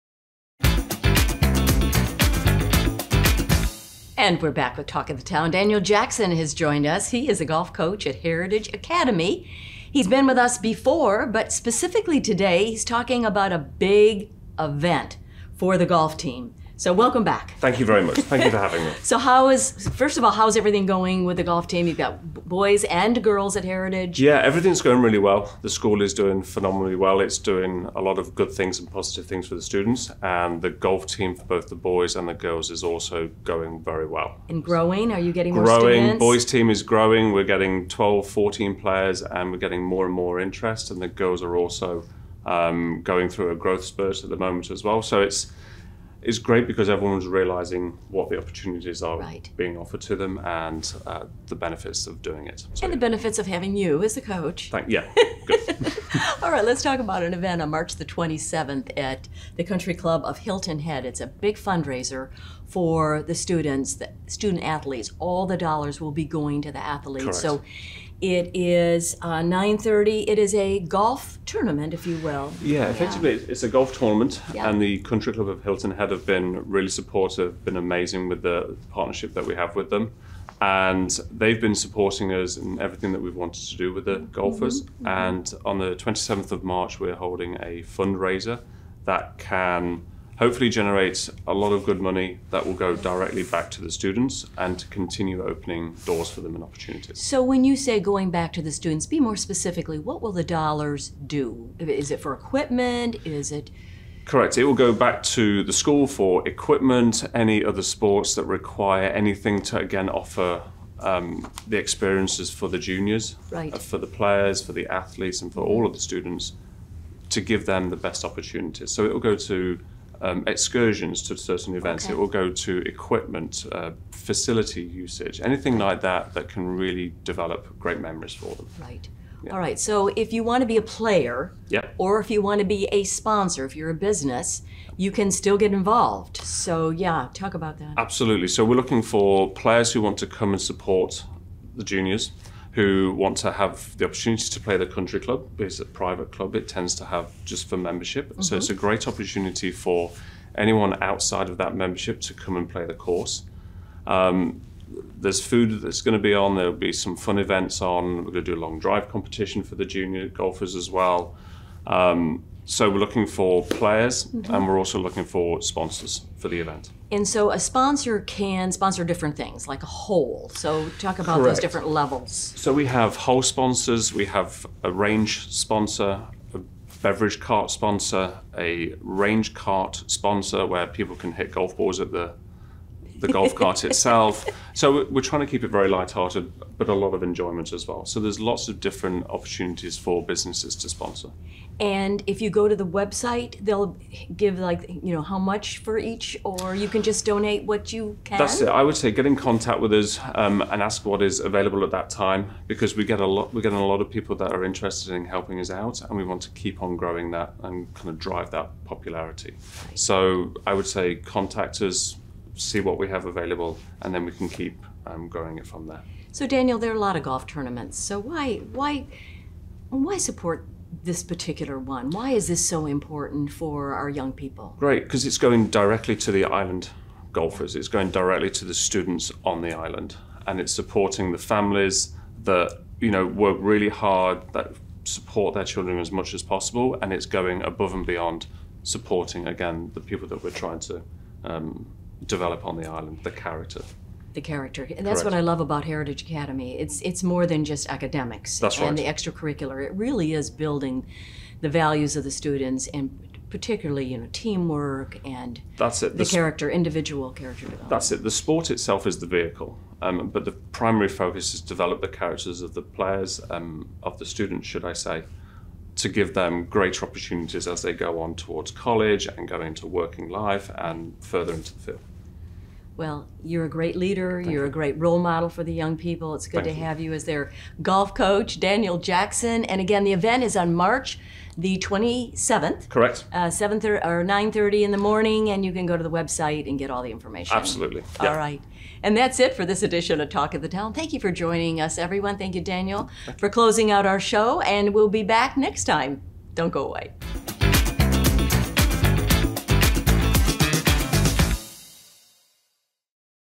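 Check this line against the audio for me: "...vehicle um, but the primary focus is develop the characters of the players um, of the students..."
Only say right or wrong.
right.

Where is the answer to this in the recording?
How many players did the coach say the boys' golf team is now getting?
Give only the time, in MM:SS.
00:37.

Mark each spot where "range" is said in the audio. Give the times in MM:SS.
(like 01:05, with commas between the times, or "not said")
02:54, 02:59.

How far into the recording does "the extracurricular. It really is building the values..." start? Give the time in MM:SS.
04:08.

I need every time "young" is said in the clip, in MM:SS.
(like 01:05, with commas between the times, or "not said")
03:44, 04:35.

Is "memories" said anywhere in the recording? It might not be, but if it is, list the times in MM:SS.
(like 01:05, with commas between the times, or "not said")
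02:07.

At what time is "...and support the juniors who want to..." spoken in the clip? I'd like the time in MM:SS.
02:20.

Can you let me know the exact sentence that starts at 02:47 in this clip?
And so a sponsor can sponsor different things, like a hole.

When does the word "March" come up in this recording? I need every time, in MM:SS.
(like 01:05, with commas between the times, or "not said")
00:57, 01:26, 04:40.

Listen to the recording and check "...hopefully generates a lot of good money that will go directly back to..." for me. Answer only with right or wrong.
right.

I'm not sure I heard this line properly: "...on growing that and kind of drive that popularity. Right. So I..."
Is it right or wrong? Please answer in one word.
right.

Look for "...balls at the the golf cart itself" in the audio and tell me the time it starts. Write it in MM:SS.
03:01.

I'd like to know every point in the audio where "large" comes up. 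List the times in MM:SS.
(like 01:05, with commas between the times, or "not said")
not said.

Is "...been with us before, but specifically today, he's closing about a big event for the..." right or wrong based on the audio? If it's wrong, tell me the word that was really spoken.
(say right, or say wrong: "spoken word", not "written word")
wrong: "talking", not "closing".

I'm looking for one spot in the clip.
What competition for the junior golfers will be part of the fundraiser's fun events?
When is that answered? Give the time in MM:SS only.
02:38.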